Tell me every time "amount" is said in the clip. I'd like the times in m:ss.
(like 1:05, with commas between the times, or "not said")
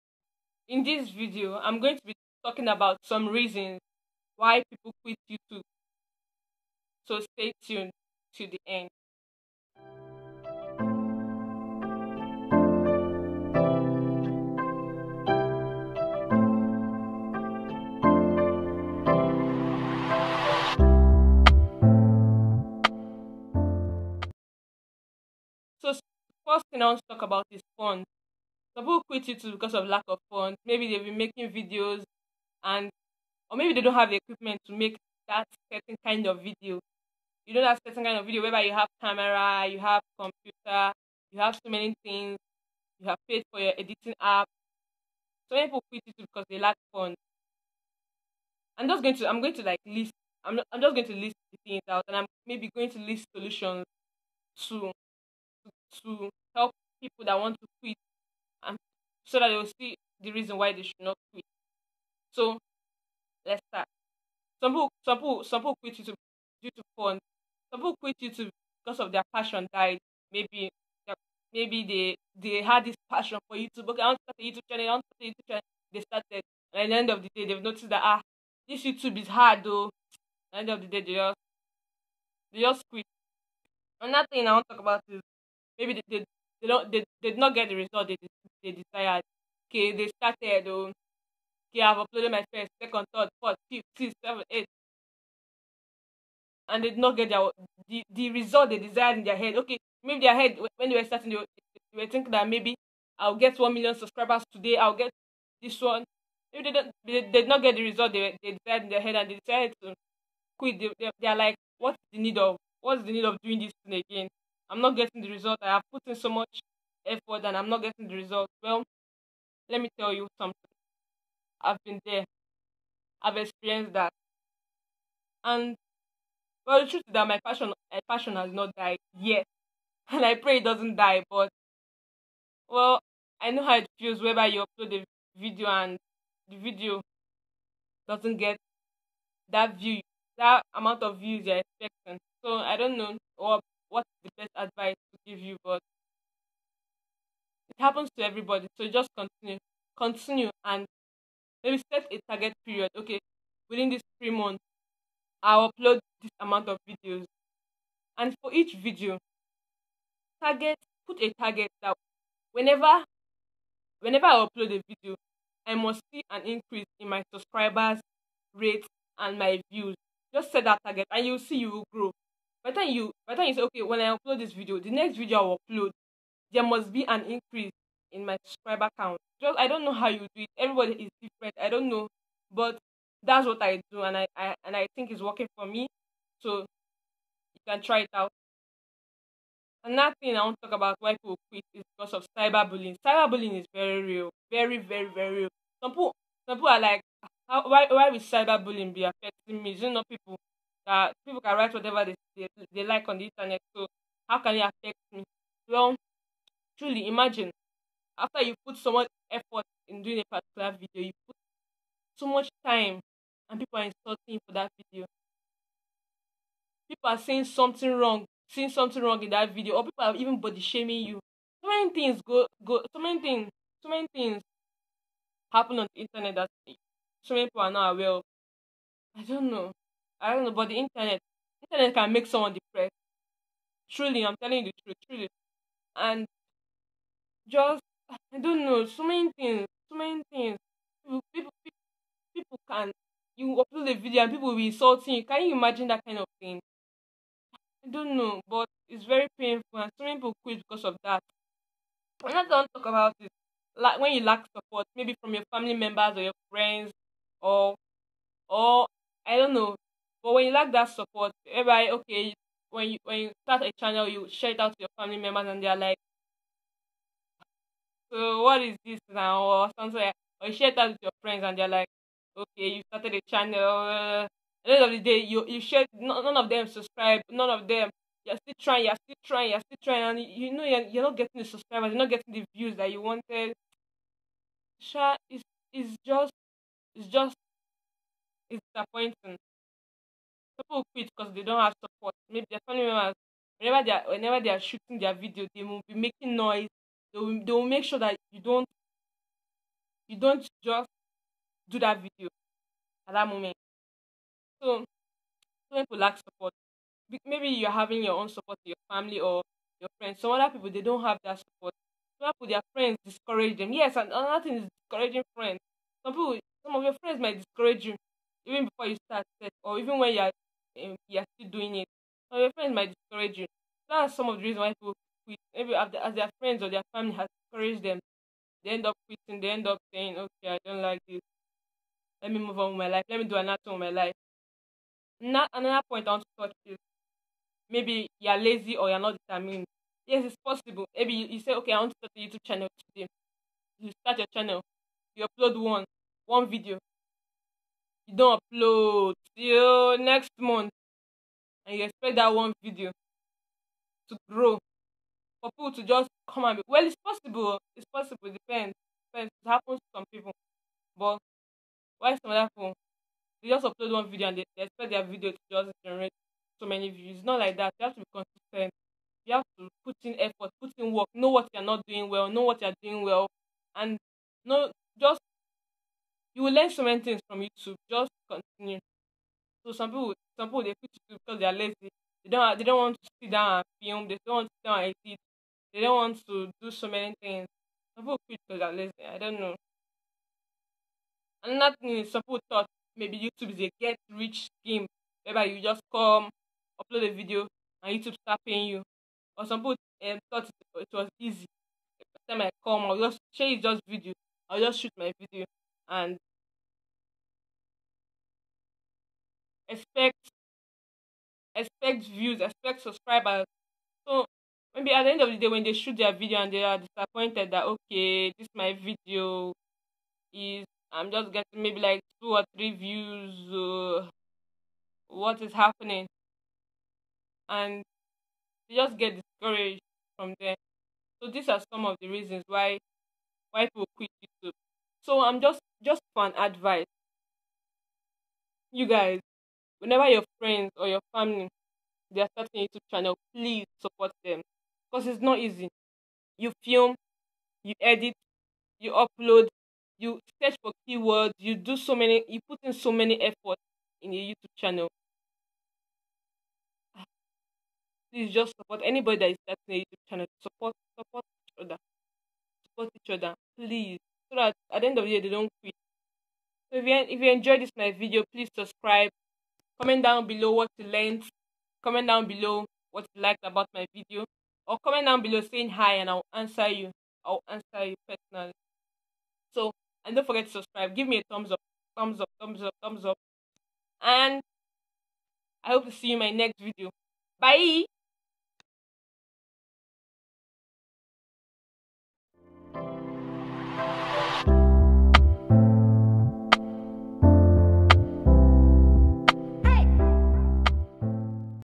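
2:20, 2:36.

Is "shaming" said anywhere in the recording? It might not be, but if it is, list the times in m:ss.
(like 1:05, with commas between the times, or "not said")
3:40.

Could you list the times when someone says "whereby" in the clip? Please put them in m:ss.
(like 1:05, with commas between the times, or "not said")
0:38, 6:35.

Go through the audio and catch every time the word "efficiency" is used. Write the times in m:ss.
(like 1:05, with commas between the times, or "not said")
not said.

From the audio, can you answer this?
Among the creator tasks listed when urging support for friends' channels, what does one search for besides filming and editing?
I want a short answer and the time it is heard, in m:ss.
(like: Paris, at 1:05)
Keywords, at 7:30.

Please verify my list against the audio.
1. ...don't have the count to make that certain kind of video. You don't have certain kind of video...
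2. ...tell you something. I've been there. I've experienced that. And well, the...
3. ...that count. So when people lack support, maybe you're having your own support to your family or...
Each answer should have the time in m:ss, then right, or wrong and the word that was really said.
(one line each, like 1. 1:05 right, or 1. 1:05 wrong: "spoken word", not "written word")
1. 0:33 wrong: "equipment", not "count"
2. 1:59 right
3. 5:03 wrong: "moment", not "count".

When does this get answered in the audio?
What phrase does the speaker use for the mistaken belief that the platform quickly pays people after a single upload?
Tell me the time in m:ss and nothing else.
6:33.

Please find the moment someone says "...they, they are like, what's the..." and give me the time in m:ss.
1:50.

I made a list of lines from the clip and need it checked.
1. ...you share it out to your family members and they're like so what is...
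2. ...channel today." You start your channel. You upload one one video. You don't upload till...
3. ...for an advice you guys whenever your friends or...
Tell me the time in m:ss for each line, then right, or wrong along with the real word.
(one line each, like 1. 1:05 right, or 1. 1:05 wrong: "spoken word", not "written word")
1. 4:24 right
2. 5:42 right
3. 7:16 right.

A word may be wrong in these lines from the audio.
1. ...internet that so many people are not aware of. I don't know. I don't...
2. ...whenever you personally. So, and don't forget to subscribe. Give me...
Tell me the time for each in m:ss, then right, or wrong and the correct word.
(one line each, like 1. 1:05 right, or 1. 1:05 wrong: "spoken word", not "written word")
1. 3:46 right
2. 7:57 wrong: "answer", not "whenever".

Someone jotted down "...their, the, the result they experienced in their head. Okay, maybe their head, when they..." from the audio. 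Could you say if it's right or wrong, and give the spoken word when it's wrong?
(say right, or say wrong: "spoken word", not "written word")
wrong: "desired", not "experienced".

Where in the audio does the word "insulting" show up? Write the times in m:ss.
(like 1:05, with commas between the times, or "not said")
3:33, 4:04.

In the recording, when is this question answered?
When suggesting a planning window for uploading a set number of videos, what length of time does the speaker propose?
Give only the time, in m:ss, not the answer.
2:34.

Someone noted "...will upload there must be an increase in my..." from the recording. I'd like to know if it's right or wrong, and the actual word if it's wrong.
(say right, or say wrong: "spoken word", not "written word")
right.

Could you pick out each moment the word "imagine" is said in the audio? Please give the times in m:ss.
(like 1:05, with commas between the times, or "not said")
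3:27, 4:05.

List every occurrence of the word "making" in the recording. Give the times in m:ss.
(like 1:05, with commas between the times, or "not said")
0:31, 4:55.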